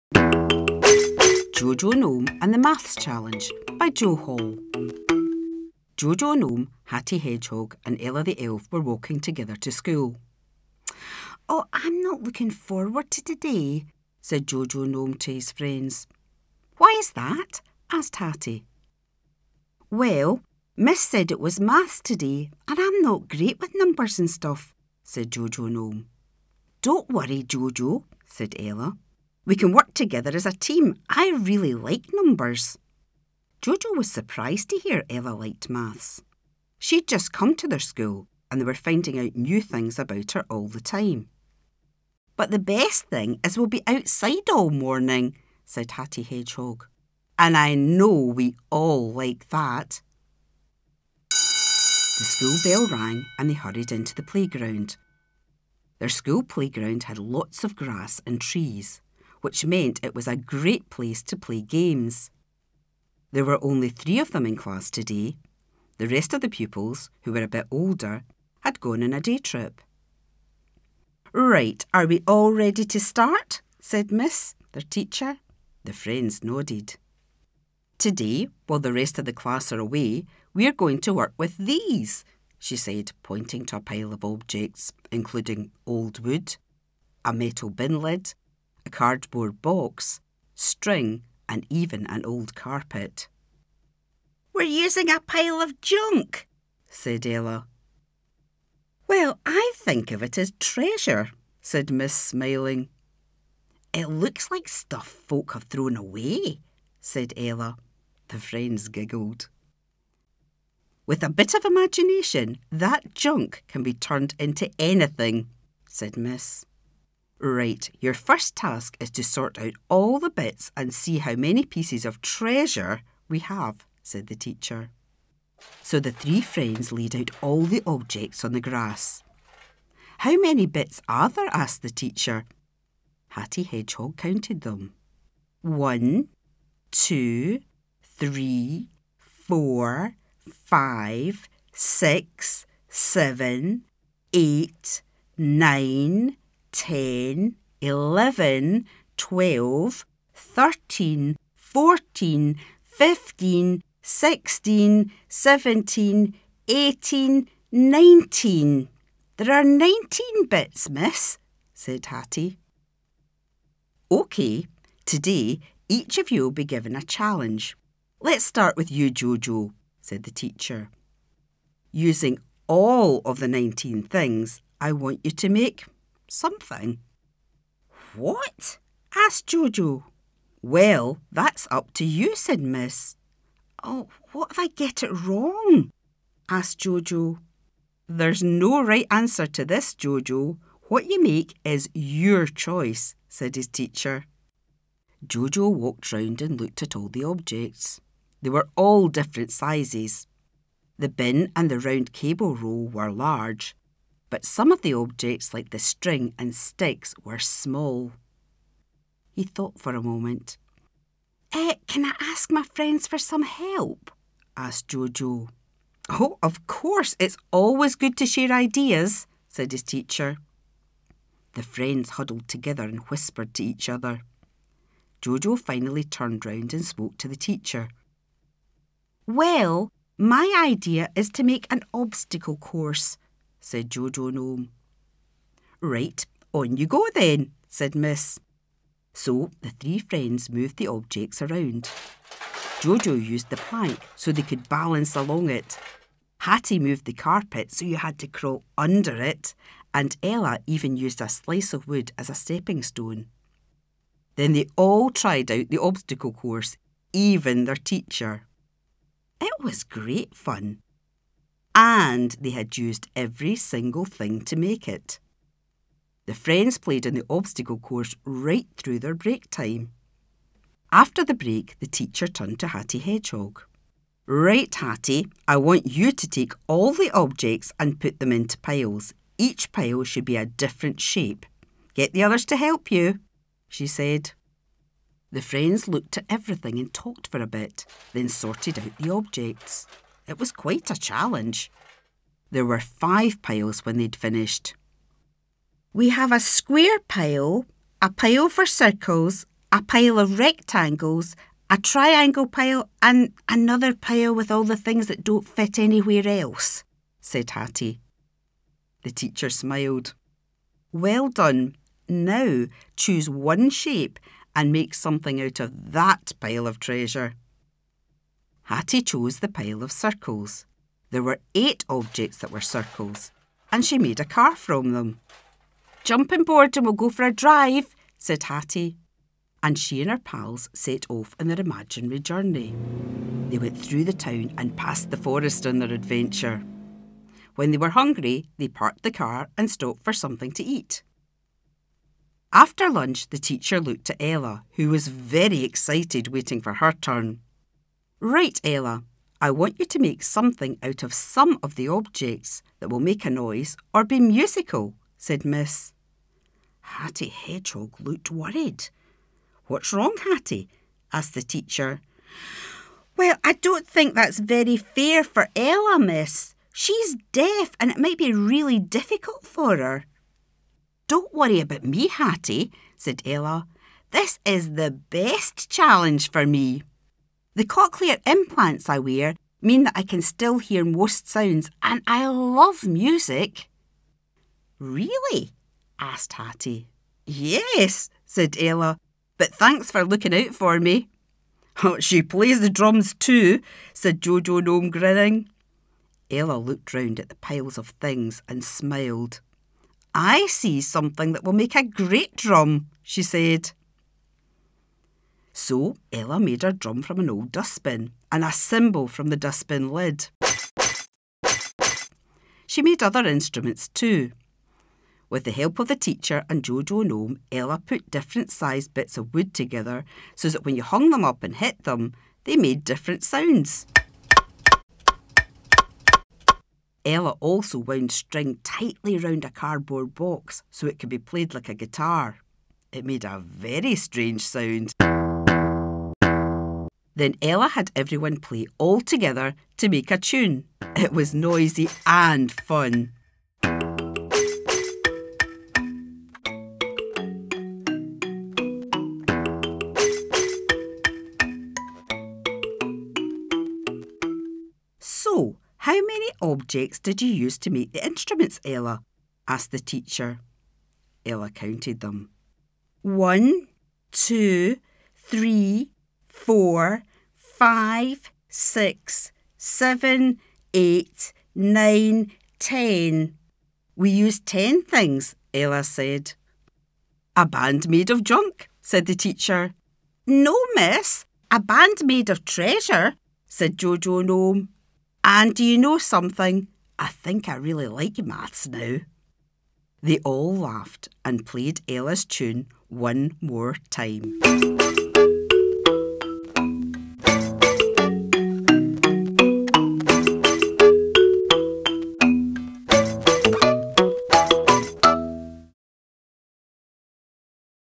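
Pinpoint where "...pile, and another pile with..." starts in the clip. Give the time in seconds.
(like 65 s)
302 s.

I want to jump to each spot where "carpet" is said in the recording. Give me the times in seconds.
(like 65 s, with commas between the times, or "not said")
92 s, 247 s.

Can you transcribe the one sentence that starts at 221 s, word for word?
The friends huddled together and whispered to each other.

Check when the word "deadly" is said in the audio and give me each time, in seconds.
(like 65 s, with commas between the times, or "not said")
not said.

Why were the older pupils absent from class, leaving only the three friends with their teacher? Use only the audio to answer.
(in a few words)
A day trip.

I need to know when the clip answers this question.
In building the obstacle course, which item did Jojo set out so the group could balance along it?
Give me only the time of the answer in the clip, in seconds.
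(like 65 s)
243 s.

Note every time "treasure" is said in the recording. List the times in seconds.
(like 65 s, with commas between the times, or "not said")
100 s, 122 s, 316 s, 482 s.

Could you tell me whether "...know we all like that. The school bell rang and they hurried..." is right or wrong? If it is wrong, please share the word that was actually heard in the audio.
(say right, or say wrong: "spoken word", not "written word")
right.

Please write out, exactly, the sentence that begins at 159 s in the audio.
There are 19 bits, miss, said Hattie.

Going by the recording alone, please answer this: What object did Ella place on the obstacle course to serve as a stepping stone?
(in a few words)
A slice of wood.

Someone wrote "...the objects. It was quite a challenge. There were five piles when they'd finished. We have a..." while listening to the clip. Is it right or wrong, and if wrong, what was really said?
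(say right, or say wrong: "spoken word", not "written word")
right.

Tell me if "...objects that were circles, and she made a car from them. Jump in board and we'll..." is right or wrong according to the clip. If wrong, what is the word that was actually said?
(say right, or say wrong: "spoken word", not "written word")
right.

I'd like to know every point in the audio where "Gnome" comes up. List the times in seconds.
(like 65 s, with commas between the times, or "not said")
1 s, 6 s, 14 s, 25 s, 234 s, 394 s, 484 s.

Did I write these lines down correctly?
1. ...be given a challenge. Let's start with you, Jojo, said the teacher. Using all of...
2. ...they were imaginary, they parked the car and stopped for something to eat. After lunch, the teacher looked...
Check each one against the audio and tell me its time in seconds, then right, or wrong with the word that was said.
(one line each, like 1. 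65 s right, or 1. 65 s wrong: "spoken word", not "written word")
1. 166 s right
2. 337 s wrong: "hungry", not "imaginary".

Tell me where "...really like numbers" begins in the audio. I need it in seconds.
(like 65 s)
31 s.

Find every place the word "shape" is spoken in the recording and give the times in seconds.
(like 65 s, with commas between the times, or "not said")
280 s, 313 s.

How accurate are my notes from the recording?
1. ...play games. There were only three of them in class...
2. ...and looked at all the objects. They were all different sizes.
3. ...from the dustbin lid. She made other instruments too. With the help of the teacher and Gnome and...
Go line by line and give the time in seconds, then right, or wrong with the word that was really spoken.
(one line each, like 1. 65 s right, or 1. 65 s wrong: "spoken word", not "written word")
1. 61 s right
2. 196 s right
3. 409 s wrong: "Jojo", not "Gnome".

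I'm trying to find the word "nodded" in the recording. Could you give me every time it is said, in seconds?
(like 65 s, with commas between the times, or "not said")
76 s.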